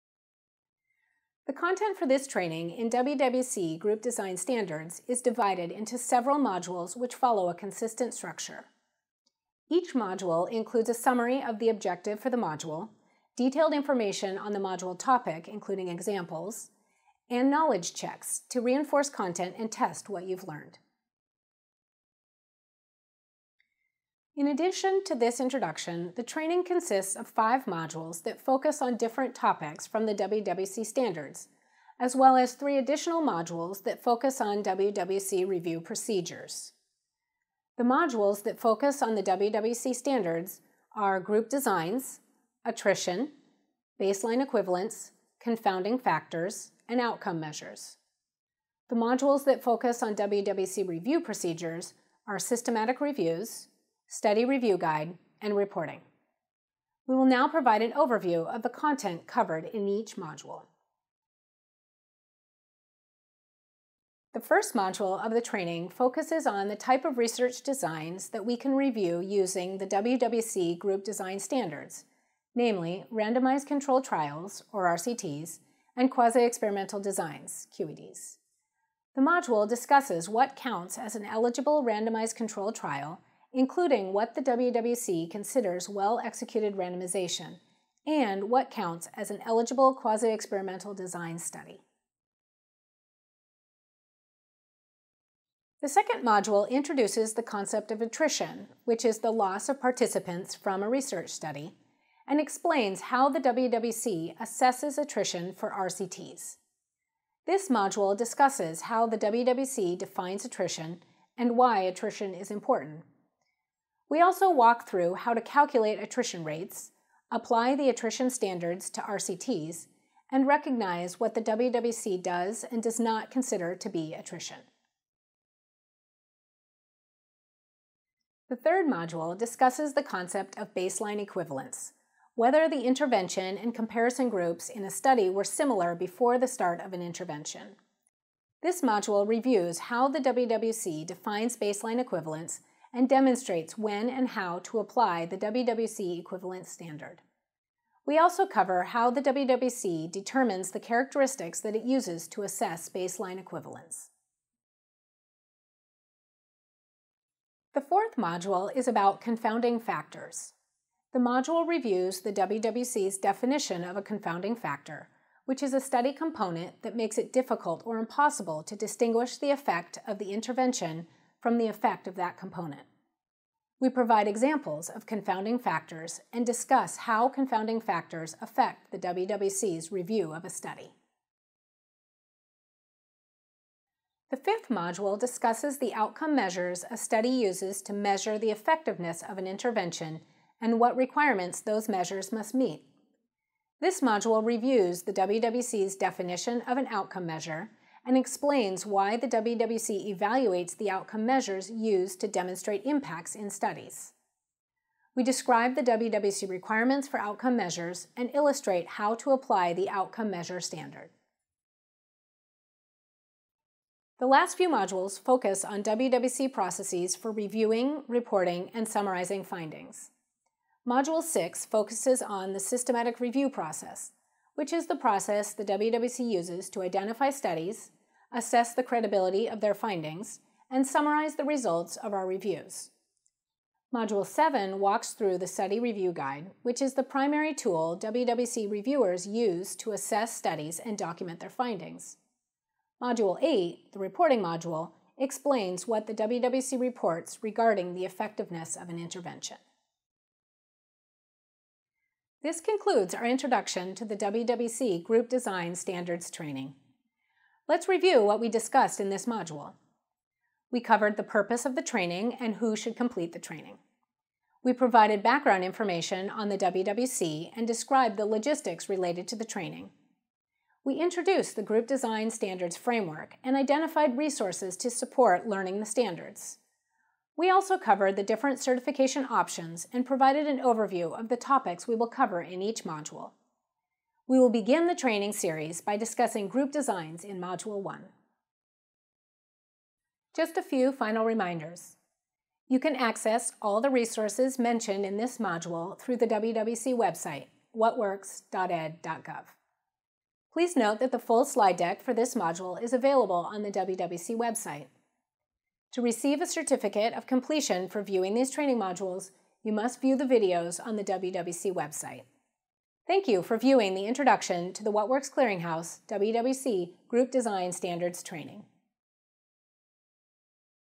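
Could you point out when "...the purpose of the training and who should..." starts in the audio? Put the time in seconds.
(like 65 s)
261 s.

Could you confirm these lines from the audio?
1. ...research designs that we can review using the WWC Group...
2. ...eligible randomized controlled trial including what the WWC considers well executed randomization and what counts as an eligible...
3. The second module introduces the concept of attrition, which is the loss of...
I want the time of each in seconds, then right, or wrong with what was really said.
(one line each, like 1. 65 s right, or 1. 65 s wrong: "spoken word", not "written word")
1. 67 s right
2. 81 s right
3. 95 s right.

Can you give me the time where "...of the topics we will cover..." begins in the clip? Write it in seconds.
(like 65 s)
281 s.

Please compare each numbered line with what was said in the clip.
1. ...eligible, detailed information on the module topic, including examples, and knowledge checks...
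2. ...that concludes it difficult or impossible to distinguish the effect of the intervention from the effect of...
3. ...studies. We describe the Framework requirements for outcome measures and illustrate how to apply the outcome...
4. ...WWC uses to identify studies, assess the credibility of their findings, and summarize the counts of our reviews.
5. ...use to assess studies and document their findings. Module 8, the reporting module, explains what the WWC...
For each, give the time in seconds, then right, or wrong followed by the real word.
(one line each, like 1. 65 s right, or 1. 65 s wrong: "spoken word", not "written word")
1. 12 s wrong: "module", not "eligible"
2. 166 s wrong: "makes", not "concludes"
3. 203 s wrong: "WWC", not "Framework"
4. 225 s wrong: "results", not "counts"
5. 239 s right.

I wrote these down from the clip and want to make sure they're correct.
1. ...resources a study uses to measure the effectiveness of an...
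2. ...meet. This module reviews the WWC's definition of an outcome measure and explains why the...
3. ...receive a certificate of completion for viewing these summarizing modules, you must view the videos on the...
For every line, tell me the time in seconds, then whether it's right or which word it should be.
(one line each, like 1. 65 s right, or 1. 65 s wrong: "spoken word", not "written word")
1. 186 s wrong: "measures", not "resources"
2. 192 s right
3. 306 s wrong: "training", not "summarizing".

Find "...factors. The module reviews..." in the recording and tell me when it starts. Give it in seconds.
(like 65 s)
159 s.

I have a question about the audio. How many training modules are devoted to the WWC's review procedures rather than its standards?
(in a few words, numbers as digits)
3.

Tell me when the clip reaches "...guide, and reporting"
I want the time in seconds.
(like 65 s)
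54 s.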